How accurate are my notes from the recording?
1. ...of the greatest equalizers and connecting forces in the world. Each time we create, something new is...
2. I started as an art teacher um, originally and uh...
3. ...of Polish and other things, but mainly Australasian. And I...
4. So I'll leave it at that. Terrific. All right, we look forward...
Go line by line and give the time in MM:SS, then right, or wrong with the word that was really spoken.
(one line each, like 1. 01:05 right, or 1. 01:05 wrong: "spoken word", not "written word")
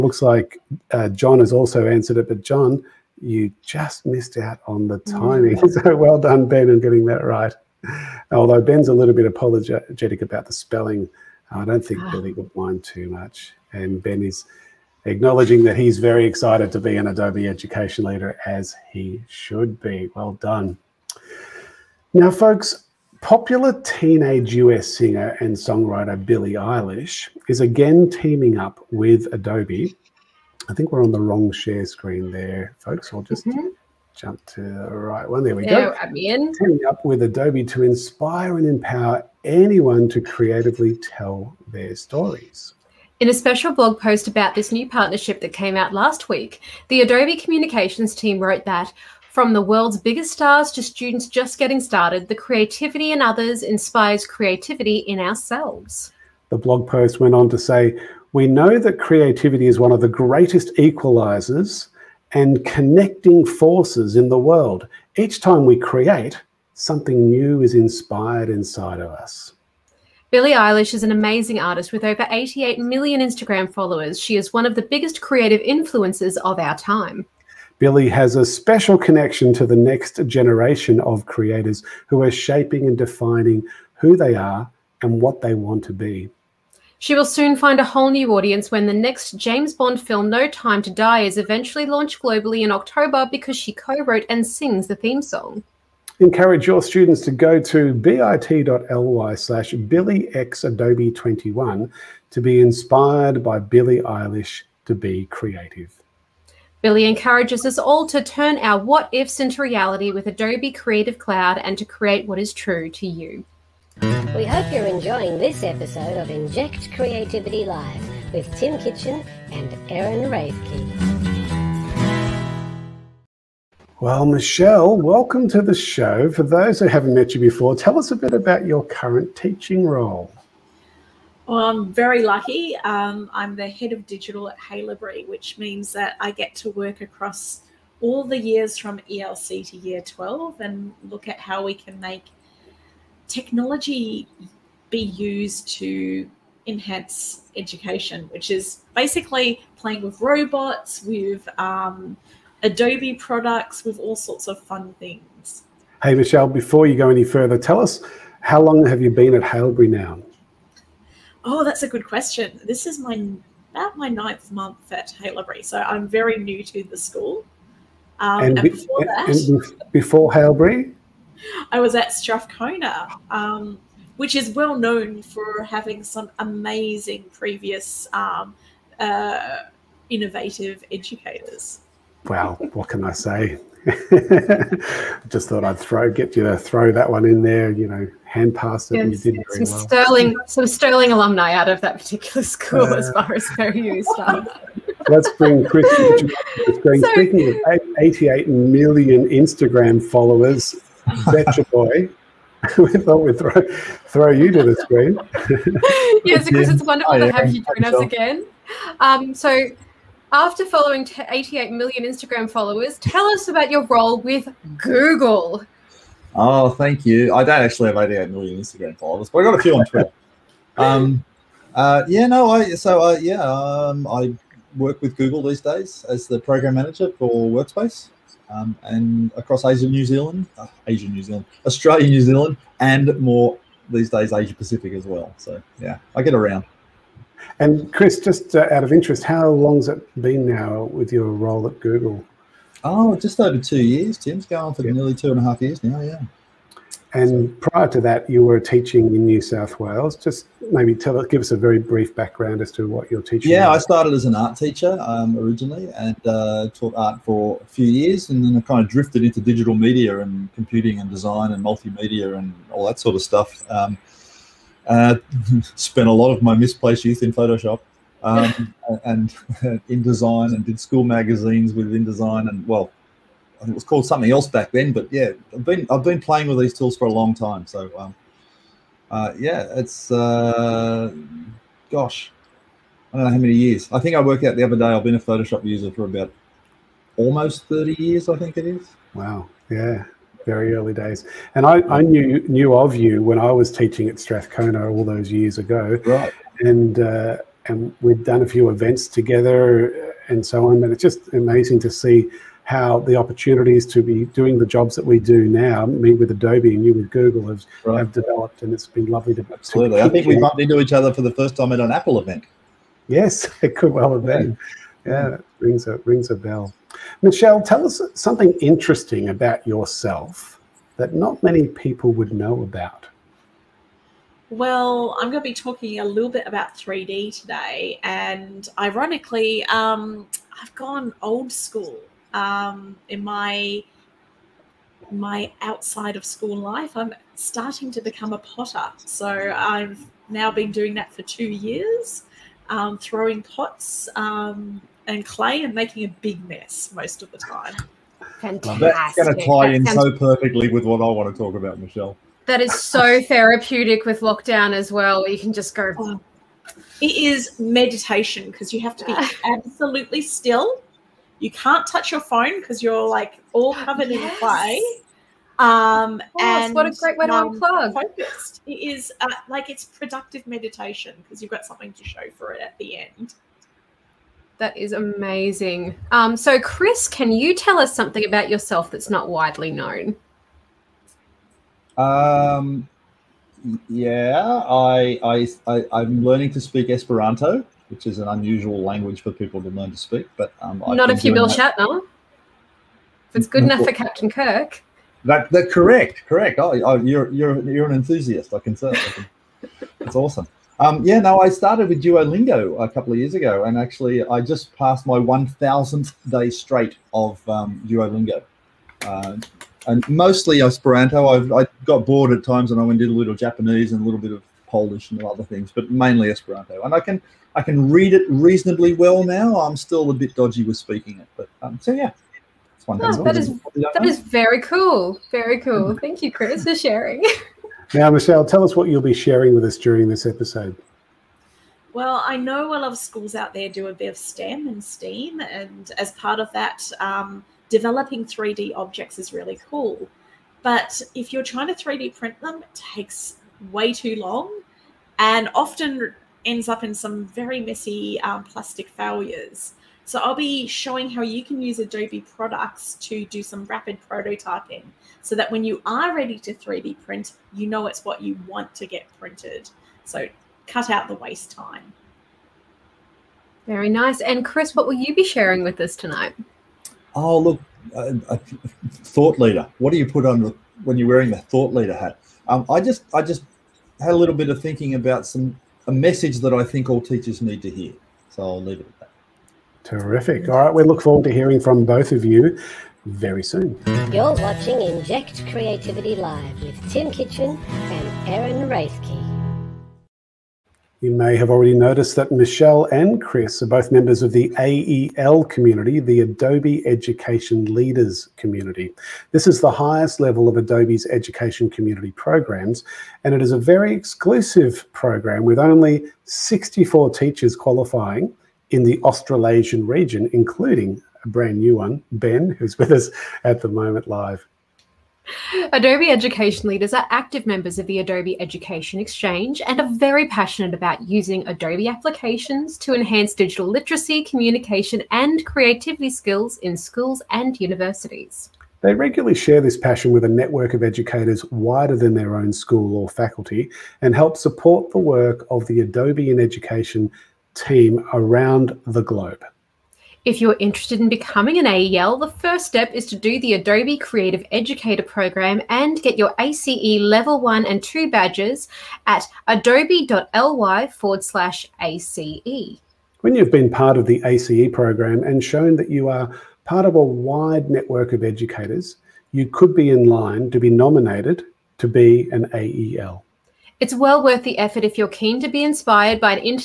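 1. 00:59 right
2. 04:13 right
3. 06:54 wrong: "Esperanto", not "Australasian"
4. 07:58 right.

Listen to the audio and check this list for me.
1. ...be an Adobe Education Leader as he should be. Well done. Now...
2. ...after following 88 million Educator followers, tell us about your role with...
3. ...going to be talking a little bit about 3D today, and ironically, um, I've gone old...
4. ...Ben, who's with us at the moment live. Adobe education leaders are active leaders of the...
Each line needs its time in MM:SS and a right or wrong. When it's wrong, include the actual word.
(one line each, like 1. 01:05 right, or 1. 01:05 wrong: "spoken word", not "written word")
1. 00:16 right
2. 03:30 wrong: "Instagram", not "Educator"
3. 05:25 right
4. 08:32 wrong: "members", not "leaders".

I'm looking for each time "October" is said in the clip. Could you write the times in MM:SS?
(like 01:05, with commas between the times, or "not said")
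01:32.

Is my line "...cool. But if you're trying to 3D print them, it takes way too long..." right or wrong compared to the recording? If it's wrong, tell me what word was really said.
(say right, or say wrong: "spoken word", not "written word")
right.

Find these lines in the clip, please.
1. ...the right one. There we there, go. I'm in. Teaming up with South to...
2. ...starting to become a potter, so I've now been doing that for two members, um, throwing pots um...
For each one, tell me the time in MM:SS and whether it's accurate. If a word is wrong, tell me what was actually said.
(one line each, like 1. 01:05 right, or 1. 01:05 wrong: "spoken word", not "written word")
1. 00:34 wrong: "Adobe", not "South"
2. 05:37 wrong: "years", not "members".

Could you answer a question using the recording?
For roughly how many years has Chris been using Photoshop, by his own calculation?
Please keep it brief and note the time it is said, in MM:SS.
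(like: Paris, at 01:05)
30, at 04:47.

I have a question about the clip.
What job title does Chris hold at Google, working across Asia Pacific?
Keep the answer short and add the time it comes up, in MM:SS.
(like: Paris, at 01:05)
Program manager for Workspace, at 03:46.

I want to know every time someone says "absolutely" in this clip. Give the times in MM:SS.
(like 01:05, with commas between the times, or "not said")
05:09, 05:59.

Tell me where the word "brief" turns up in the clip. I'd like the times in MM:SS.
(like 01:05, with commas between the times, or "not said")
04:11.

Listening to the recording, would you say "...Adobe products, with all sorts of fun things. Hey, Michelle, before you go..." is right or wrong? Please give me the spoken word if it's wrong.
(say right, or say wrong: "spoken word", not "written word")
right.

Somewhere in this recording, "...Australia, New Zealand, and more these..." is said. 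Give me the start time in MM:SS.
03:51.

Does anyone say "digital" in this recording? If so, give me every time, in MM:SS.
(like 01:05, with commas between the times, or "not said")
02:14, 04:19, 08:43.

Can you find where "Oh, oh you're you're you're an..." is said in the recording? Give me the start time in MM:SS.
06:36.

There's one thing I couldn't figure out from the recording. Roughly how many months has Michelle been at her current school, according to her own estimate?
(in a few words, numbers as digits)
9.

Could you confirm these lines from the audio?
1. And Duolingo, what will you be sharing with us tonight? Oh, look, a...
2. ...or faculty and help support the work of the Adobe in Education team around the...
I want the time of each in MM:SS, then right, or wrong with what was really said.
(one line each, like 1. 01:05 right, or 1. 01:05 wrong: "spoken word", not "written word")
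1. 07:44 wrong: "Chris", not "Duolingo"
2. 08:52 right.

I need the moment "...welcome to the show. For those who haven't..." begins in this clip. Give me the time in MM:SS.
02:04.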